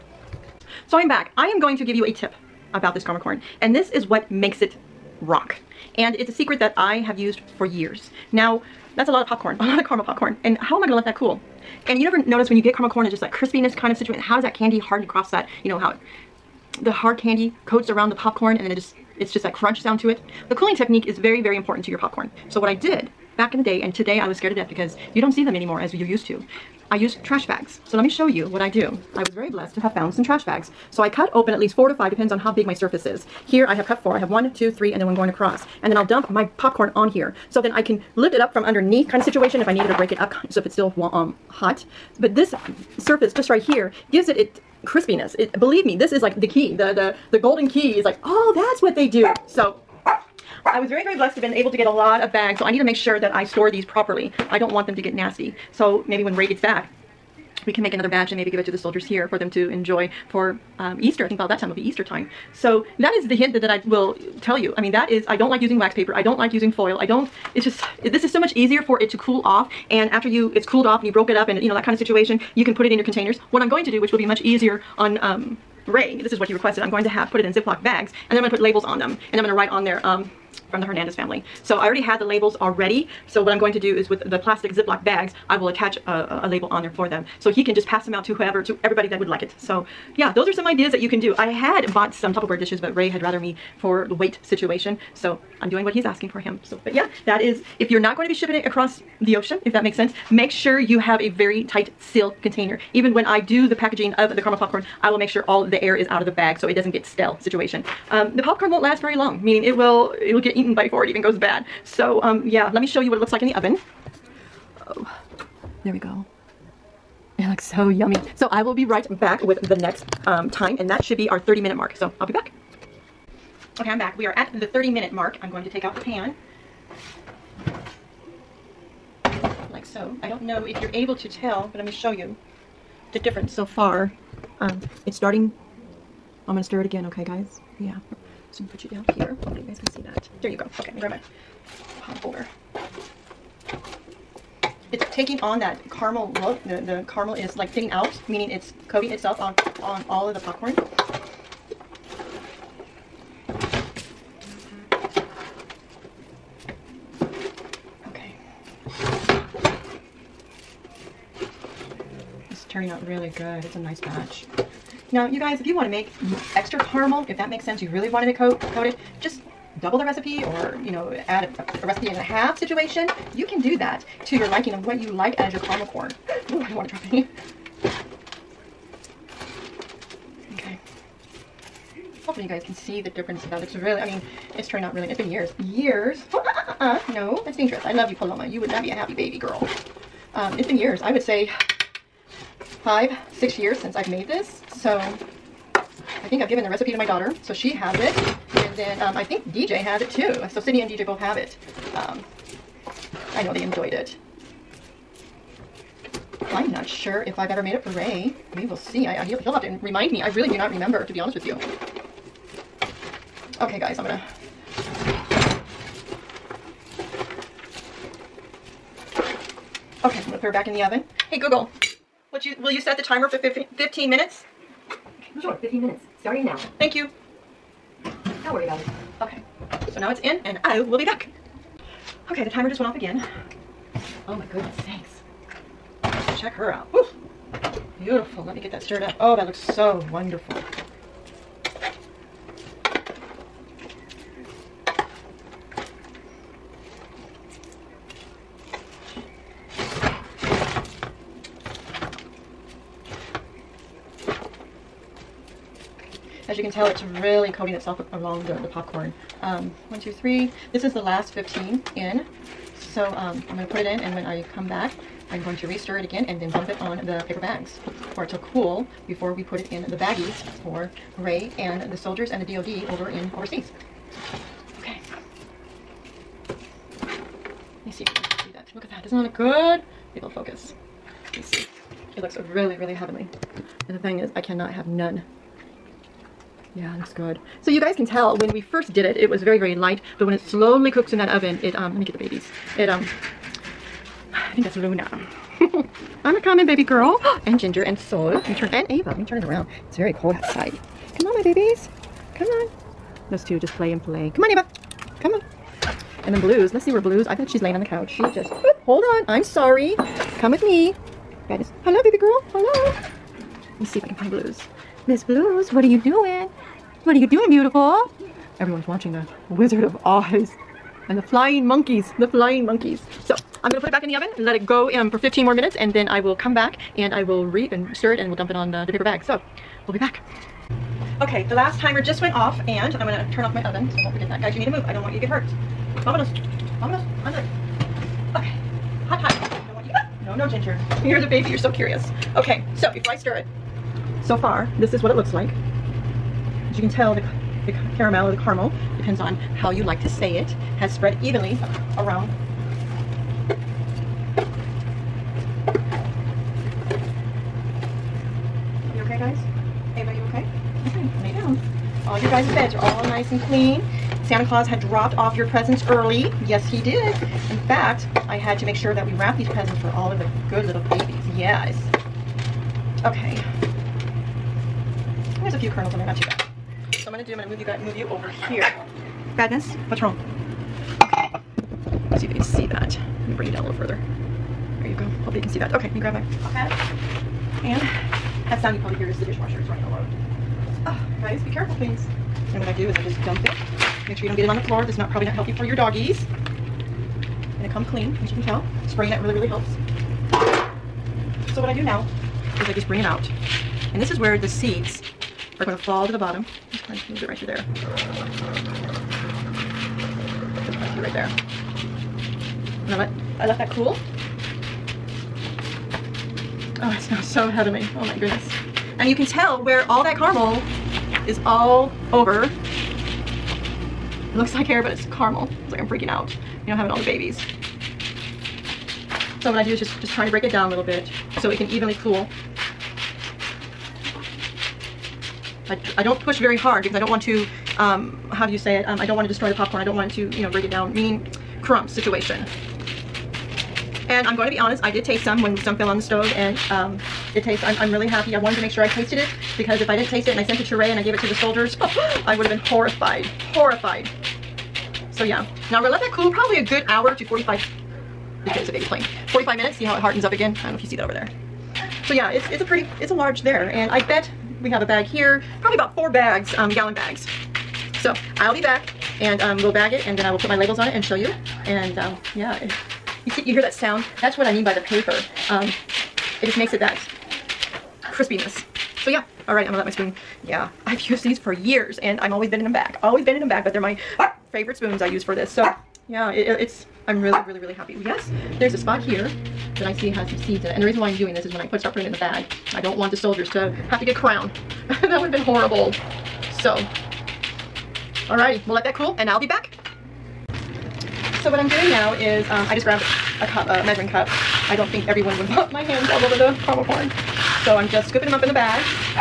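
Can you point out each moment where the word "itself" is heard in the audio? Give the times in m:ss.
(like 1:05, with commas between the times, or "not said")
2:29, 4:17.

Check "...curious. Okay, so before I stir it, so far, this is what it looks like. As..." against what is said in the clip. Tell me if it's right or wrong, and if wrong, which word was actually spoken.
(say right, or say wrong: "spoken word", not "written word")
right.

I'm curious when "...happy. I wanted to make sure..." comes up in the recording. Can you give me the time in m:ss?
7:28.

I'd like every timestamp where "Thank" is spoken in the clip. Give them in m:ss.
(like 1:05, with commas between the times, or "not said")
3:46.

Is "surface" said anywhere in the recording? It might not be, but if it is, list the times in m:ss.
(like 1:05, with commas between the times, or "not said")
0:32, 0:42.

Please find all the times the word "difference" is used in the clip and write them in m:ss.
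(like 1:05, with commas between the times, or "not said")
2:13, 3:03.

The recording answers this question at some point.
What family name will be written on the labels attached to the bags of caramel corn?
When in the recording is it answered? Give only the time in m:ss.
1:20.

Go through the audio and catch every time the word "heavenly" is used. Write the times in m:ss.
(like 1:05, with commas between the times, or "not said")
4:42, 6:57.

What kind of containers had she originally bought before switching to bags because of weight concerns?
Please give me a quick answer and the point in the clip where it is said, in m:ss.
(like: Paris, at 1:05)
Tupperware dishes, at 1:32.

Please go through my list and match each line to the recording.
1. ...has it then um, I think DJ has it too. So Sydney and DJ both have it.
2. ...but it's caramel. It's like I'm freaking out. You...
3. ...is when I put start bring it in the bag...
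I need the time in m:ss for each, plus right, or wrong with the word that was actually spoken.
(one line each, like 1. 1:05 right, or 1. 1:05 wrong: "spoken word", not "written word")
1. 3:17 right
2. 7:04 right
3. 8:11 wrong: "putting", not "bring".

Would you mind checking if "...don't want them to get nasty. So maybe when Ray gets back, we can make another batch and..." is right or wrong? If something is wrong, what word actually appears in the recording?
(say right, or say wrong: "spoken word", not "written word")
right.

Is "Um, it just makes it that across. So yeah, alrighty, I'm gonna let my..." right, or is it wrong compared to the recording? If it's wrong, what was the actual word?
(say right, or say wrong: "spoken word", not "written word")
wrong: "crispiness", not "across".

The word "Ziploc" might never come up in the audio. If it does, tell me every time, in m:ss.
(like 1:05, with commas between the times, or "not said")
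1:17, 1:24.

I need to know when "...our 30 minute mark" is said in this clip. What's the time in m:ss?
2:01.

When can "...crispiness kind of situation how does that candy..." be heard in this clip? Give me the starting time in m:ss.
0:13.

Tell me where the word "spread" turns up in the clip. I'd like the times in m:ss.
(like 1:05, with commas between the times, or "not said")
5:50.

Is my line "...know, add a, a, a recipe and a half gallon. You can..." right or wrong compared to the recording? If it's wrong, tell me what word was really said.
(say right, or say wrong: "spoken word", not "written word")
wrong: "situation", not "gallon".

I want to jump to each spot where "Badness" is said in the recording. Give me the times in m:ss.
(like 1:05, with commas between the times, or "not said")
5:11, 6:19.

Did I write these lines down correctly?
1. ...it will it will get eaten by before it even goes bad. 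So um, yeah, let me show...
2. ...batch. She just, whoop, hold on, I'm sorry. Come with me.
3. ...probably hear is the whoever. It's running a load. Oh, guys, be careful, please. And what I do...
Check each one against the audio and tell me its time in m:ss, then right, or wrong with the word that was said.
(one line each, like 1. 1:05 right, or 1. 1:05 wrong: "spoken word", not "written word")
1. 1:49 right
2. 5:07 wrong: "couch", not "batch"
3. 6:28 wrong: "dishwasher", not "whoever".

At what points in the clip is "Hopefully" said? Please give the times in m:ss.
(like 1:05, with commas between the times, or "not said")
2:19, 3:02, 6:25.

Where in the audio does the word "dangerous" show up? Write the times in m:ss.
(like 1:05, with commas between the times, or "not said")
3:07.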